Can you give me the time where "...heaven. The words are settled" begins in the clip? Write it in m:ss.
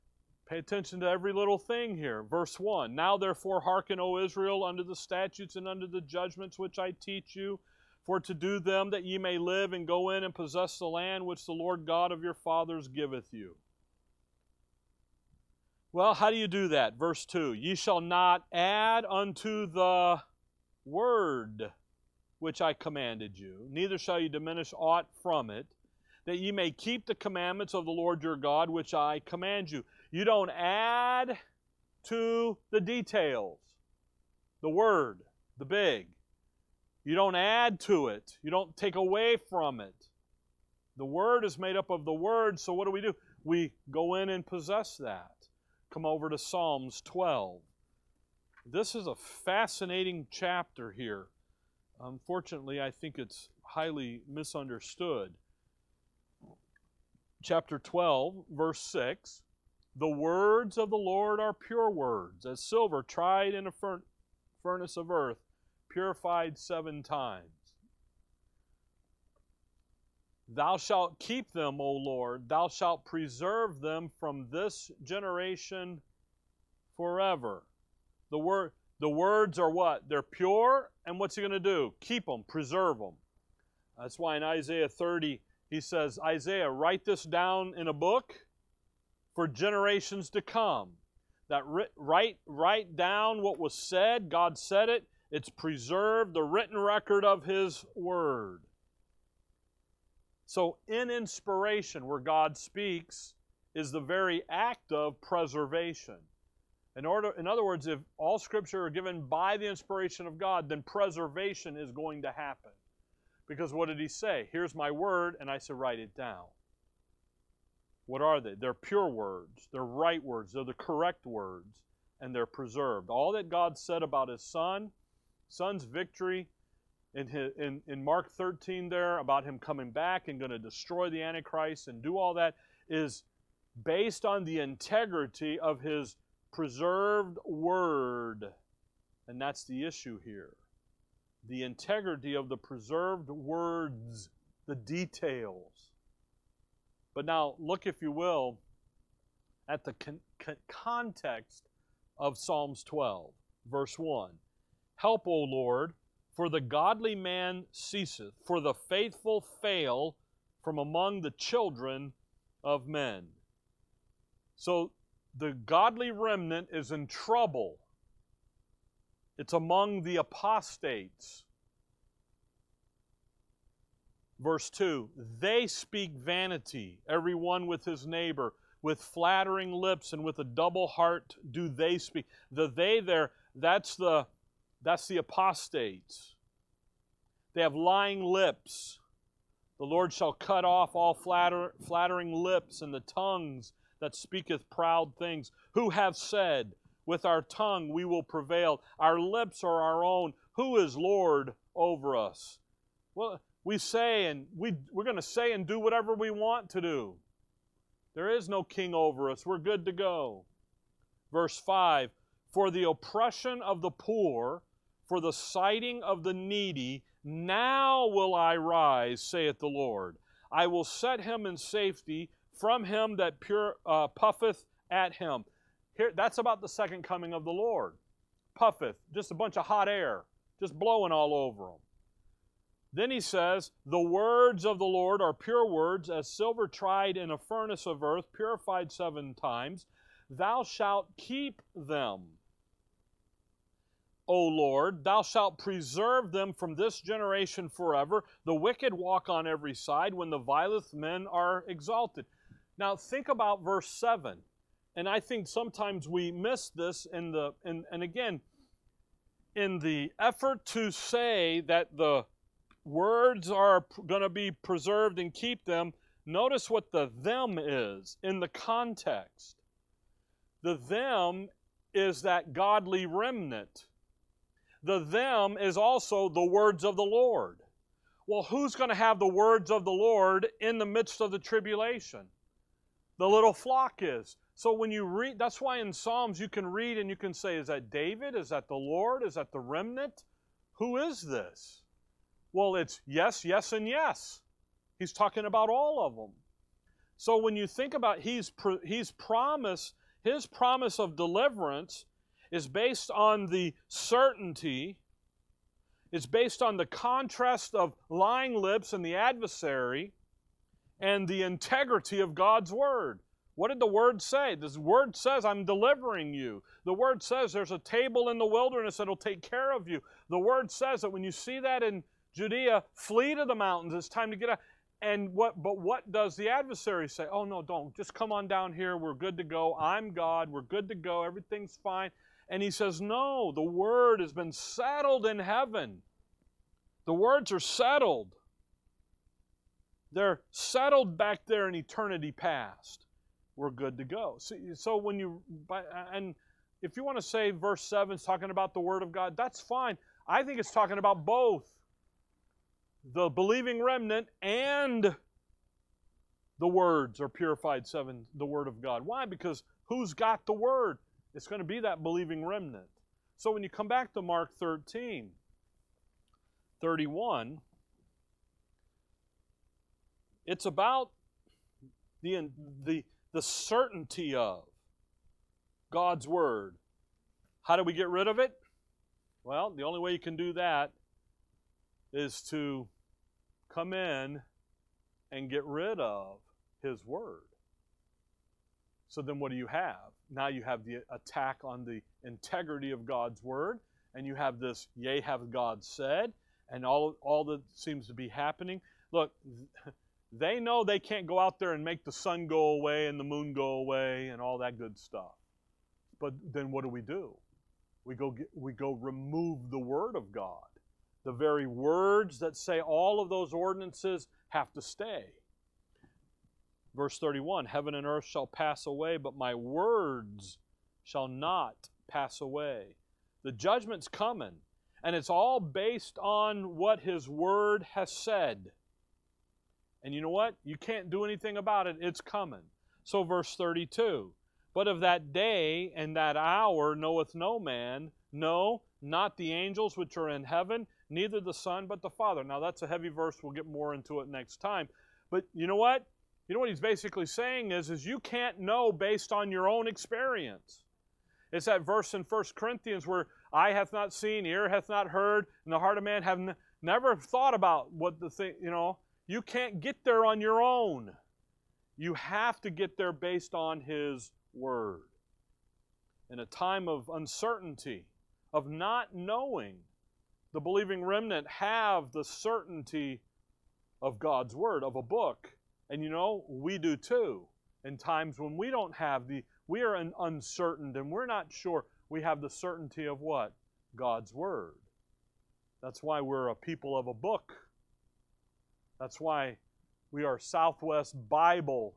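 5:35.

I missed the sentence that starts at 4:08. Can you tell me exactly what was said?
The wicked walk on every side when the vilest men are exalted.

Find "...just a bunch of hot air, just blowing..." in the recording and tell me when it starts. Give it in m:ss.
3:49.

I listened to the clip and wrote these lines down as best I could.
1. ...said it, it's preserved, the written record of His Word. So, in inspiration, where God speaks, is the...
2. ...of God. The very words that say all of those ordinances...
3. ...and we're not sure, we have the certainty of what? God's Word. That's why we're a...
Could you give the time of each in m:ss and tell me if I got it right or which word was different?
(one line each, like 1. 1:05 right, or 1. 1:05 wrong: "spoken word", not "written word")
1. 1:34 right
2. 6:50 right
3. 8:00 right.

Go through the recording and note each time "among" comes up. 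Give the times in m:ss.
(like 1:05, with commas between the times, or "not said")
2:40, 2:49.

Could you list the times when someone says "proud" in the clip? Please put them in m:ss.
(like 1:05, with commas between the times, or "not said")
3:14.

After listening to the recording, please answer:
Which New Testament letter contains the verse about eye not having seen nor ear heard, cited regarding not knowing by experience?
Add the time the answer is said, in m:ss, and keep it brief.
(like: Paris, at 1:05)
First Corinthians, at 7:32.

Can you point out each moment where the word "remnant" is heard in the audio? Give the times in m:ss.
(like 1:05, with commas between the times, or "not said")
2:46, 4:33, 4:49, 5:53, 6:02, 7:51.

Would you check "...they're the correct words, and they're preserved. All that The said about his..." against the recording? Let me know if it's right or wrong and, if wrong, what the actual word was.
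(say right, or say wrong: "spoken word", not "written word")
wrong: "God", not "The".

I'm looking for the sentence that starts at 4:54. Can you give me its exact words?
He's talking about all of them.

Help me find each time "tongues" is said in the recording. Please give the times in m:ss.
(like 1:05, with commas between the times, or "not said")
3:12, 3:17.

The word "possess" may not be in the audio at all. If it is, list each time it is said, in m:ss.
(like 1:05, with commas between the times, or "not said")
0:10, 0:44.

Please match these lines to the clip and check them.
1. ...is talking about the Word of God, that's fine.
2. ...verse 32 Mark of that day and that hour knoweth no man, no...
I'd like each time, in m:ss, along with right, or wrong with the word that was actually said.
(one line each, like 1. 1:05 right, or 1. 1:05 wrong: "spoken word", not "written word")
1. 5:48 right
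2. 7:13 wrong: "But", not "Mark".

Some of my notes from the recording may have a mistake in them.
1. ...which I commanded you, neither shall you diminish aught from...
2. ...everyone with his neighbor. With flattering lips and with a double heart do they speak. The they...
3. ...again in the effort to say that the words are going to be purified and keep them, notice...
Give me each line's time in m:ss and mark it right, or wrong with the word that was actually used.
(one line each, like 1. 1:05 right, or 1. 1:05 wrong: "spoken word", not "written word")
1. 0:22 right
2. 2:57 right
3. 4:18 wrong: "preserved", not "purified".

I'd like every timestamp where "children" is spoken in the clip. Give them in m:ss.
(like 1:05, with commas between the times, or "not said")
2:41.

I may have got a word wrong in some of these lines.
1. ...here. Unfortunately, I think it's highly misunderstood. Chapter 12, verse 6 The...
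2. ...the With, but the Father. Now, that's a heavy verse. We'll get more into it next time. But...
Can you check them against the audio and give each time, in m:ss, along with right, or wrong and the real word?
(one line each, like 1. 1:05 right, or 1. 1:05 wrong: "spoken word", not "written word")
1. 0:50 right
2. 7:21 wrong: "Son", not "With".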